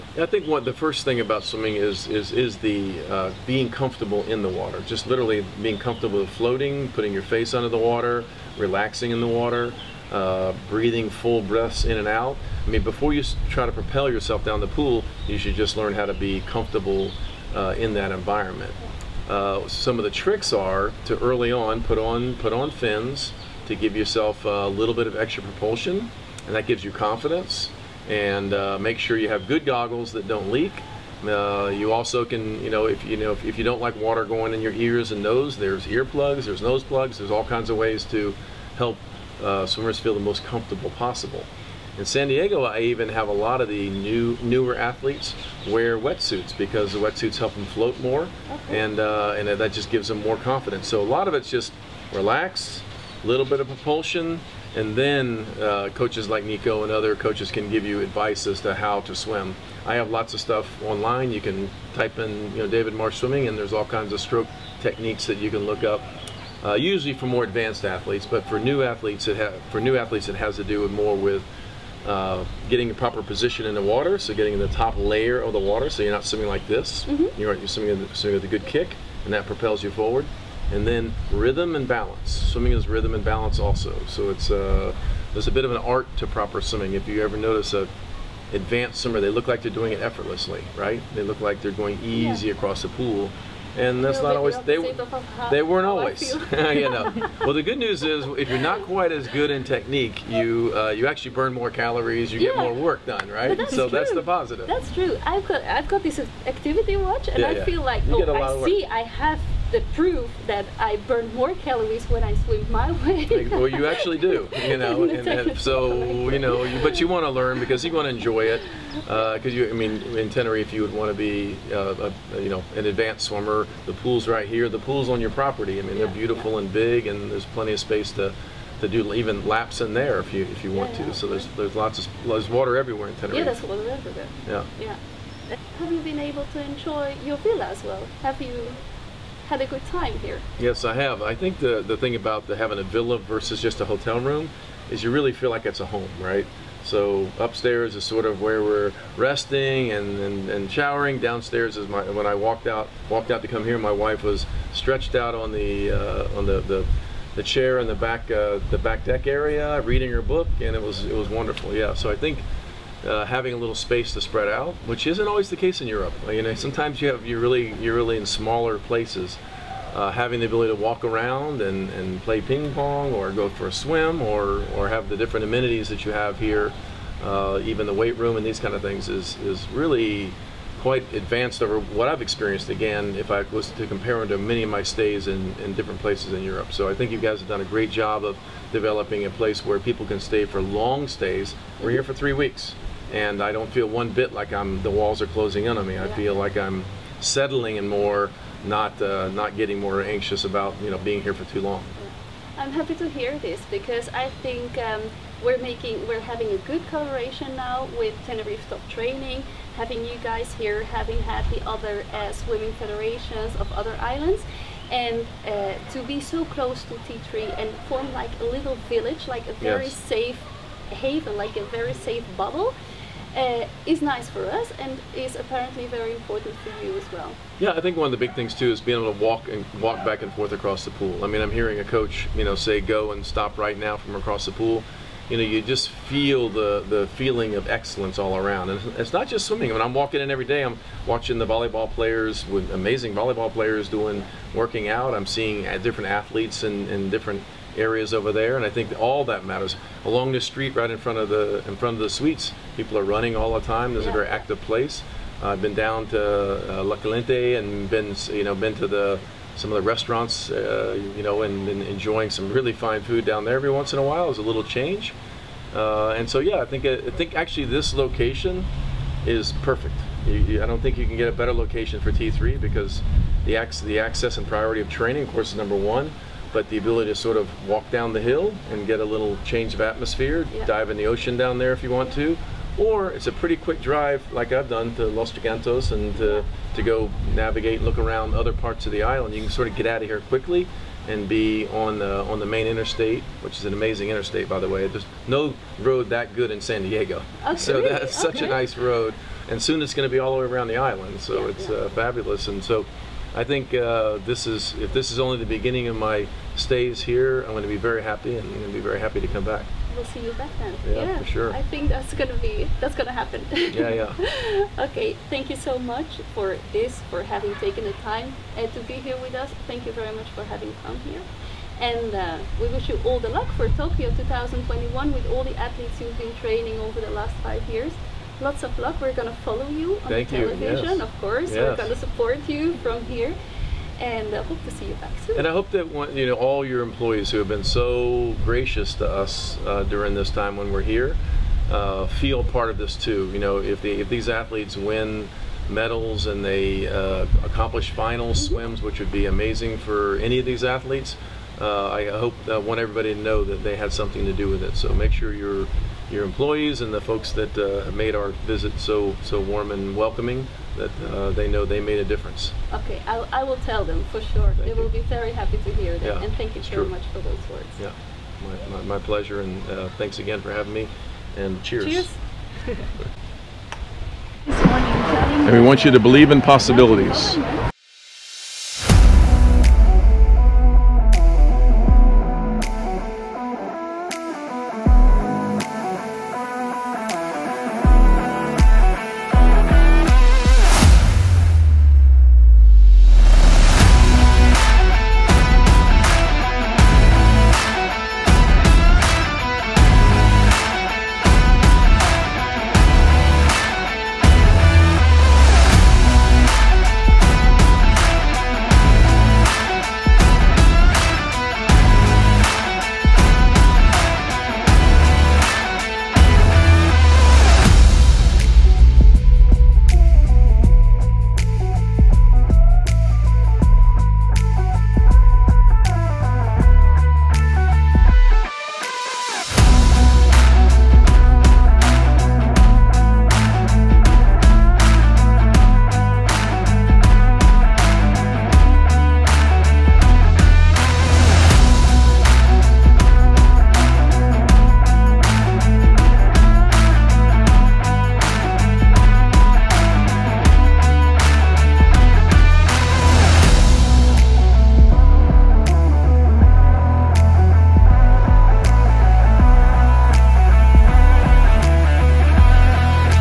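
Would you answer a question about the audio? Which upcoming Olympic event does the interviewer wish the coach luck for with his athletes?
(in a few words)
Tokyo 2021.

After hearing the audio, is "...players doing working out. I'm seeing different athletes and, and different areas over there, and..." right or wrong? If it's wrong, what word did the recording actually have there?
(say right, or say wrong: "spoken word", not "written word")
right.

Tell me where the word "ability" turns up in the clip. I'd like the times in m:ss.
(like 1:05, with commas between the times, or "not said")
2:50, 4:36.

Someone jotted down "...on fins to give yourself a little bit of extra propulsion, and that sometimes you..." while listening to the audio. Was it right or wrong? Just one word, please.
wrong.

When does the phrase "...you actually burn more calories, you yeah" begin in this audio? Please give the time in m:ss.
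1:40.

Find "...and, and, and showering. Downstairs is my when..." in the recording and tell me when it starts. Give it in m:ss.
2:29.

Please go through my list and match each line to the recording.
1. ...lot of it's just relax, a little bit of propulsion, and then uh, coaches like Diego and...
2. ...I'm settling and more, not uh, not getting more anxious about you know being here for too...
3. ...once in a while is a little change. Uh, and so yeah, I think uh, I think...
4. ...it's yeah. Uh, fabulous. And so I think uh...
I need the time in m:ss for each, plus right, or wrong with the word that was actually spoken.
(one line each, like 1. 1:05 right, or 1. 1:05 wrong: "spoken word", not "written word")
1. 0:51 wrong: "Nico", not "Diego"
2. 3:16 right
3. 4:23 right
4. 5:01 right.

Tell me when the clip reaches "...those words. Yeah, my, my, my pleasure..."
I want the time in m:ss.
6:07.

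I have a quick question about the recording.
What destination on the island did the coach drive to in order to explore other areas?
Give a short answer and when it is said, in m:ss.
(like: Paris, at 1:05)
Los Gigantes, at 4:45.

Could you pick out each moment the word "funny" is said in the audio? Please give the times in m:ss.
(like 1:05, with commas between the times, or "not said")
not said.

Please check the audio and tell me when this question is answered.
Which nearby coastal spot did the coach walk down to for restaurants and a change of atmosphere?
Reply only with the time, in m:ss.
4:16.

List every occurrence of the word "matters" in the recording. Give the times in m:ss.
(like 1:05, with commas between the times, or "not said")
4:09.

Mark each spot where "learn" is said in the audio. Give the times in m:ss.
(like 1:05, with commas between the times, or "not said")
0:15, 1:57.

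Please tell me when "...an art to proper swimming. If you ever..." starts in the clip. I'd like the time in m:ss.
1:25.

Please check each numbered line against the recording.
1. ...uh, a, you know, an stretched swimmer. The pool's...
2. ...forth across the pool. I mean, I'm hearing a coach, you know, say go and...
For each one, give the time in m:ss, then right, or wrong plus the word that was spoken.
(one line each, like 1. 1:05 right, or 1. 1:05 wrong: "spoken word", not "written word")
1. 2:01 wrong: "advanced", not "stretched"
2. 3:50 right.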